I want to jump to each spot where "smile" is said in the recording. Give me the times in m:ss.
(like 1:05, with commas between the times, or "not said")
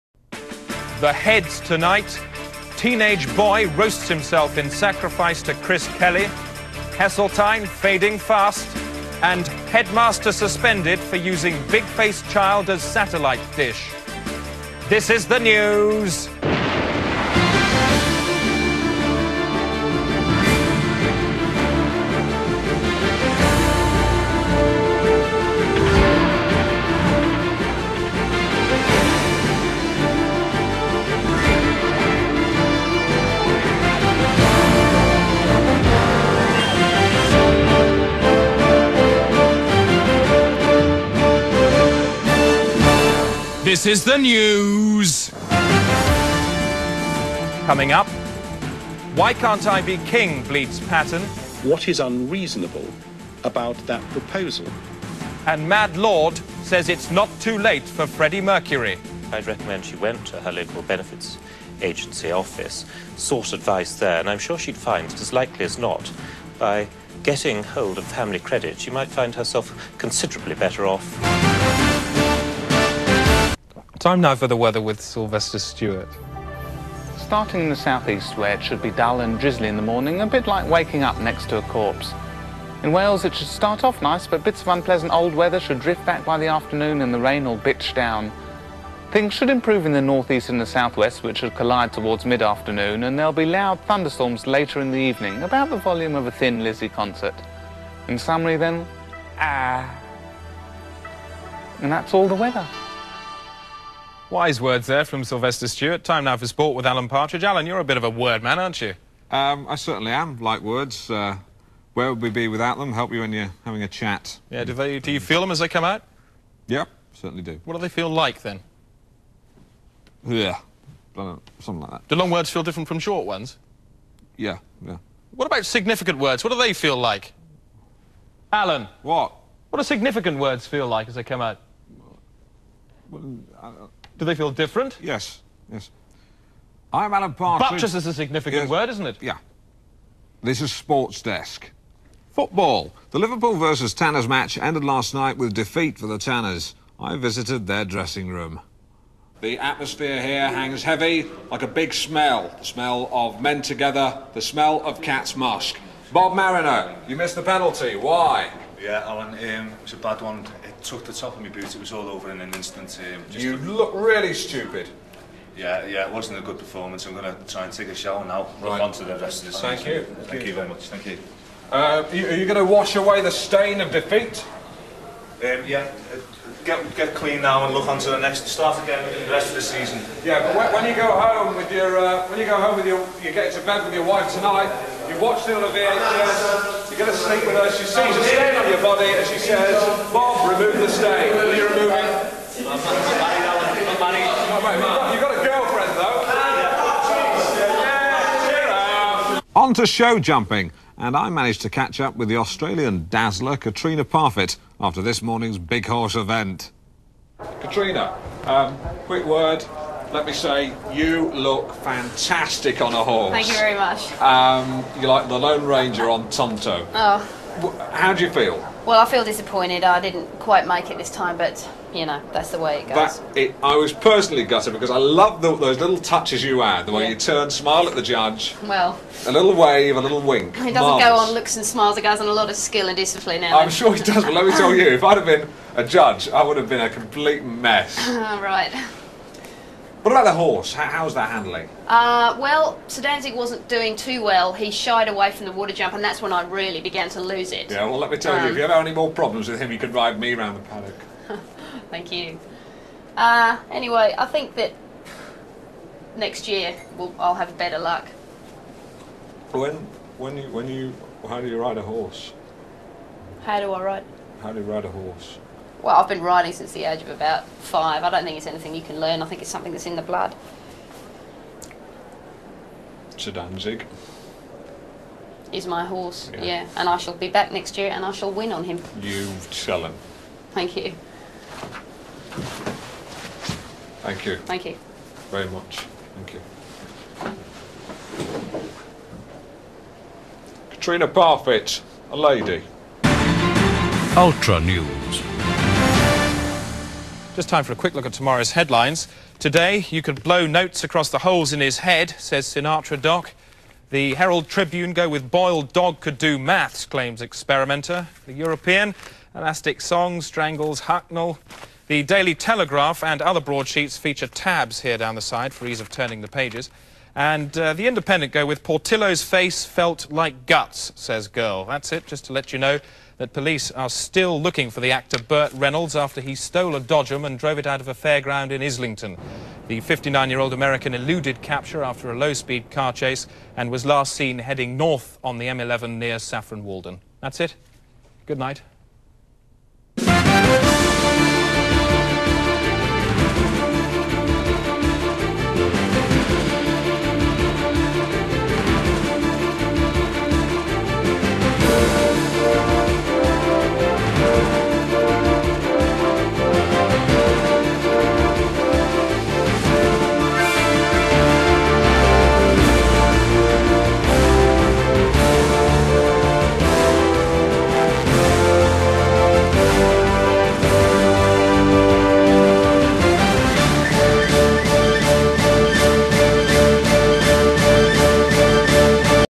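3:47, 3:51.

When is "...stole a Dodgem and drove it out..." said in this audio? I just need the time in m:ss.
5:26.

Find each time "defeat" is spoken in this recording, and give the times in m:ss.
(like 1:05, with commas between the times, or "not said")
2:25, 2:53.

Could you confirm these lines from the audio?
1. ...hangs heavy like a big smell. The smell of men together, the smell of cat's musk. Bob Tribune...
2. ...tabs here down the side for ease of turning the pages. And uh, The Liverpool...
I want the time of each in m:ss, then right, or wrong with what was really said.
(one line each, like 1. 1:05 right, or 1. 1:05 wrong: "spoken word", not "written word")
1. 2:30 wrong: "Marino", not "Tribune"
2. 5:14 wrong: "Independent", not "Liverpool".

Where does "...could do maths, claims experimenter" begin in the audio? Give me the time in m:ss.
5:06.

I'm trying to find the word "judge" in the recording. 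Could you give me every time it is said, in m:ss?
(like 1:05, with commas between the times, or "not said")
3:48, 3:55.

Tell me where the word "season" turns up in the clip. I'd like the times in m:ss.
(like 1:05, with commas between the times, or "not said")
2:49, 2:59.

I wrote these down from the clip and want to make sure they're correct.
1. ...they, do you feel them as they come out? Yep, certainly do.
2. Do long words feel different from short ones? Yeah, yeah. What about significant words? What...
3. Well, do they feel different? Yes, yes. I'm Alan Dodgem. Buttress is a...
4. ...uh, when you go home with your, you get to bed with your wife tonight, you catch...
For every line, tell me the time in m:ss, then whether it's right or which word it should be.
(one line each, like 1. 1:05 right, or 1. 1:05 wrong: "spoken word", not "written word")
1. 1:54 right
2. 2:02 right
3. 2:13 wrong: "Partridge", not "Dodgem"
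4. 3:01 wrong: "watch", not "catch".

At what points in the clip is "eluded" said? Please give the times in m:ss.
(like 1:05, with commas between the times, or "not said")
5:30.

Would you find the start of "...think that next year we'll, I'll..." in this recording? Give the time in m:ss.
4:14.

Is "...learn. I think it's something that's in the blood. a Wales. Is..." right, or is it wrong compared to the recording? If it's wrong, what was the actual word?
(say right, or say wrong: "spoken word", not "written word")
wrong: "Danzig", not "Wales".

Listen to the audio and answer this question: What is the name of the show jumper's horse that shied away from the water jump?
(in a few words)
Sedanzig.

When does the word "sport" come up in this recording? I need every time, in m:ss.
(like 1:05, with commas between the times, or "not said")
1:46, 2:20.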